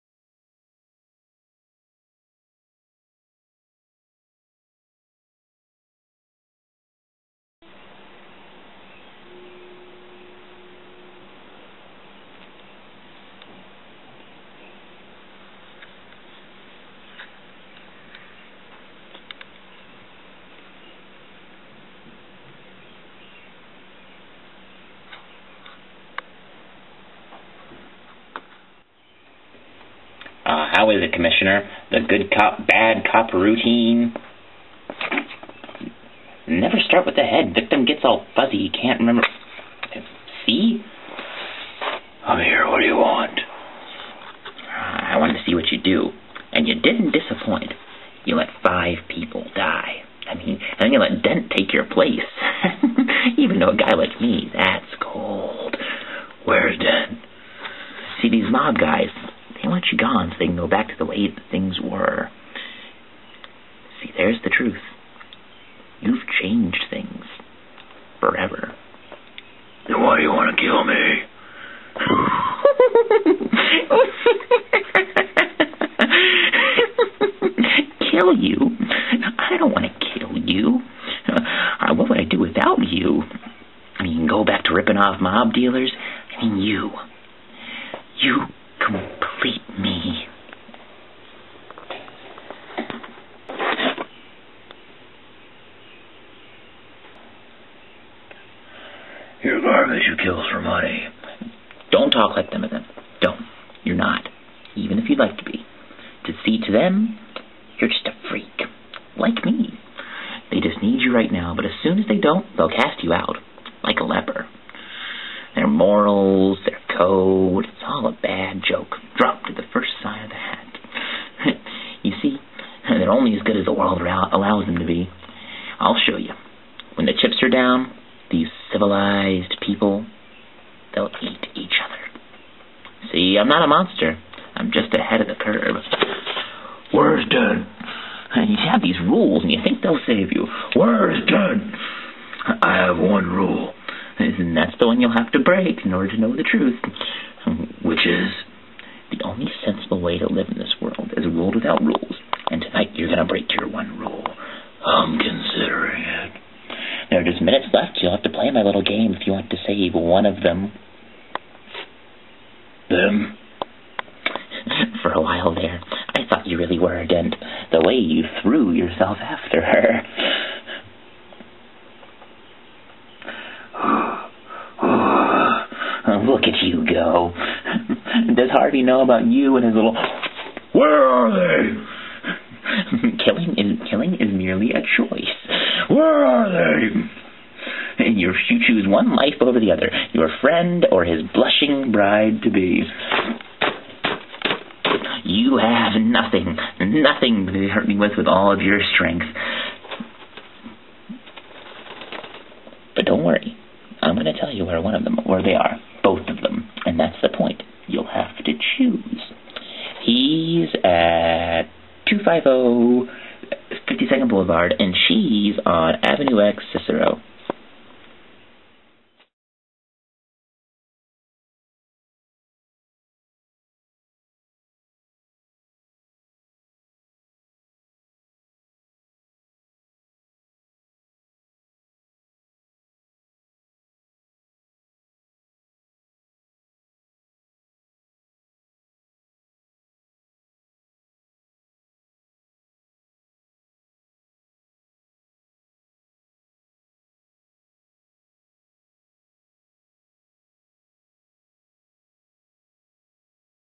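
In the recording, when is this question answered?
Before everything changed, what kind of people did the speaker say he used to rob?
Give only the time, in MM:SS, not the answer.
01:25.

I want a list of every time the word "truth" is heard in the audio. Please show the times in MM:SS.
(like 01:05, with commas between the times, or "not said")
01:04, 02:26.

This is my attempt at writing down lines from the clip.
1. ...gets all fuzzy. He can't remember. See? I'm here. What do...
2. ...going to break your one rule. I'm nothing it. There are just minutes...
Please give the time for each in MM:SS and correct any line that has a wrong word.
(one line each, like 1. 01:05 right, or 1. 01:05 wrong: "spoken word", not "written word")
1. 00:37 right
2. 02:33 wrong: "considering", not "nothing".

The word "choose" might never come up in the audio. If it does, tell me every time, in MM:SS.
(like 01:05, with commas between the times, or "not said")
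03:08, 03:28.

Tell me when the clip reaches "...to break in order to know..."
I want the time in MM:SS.
02:25.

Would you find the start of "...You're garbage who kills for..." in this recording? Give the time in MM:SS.
01:39.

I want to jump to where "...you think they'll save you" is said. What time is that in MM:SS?
02:19.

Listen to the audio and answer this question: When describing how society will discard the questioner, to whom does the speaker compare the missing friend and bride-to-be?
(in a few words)
a leper.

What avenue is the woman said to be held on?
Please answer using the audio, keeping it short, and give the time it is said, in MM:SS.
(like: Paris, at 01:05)
Avenue X, at 03:36.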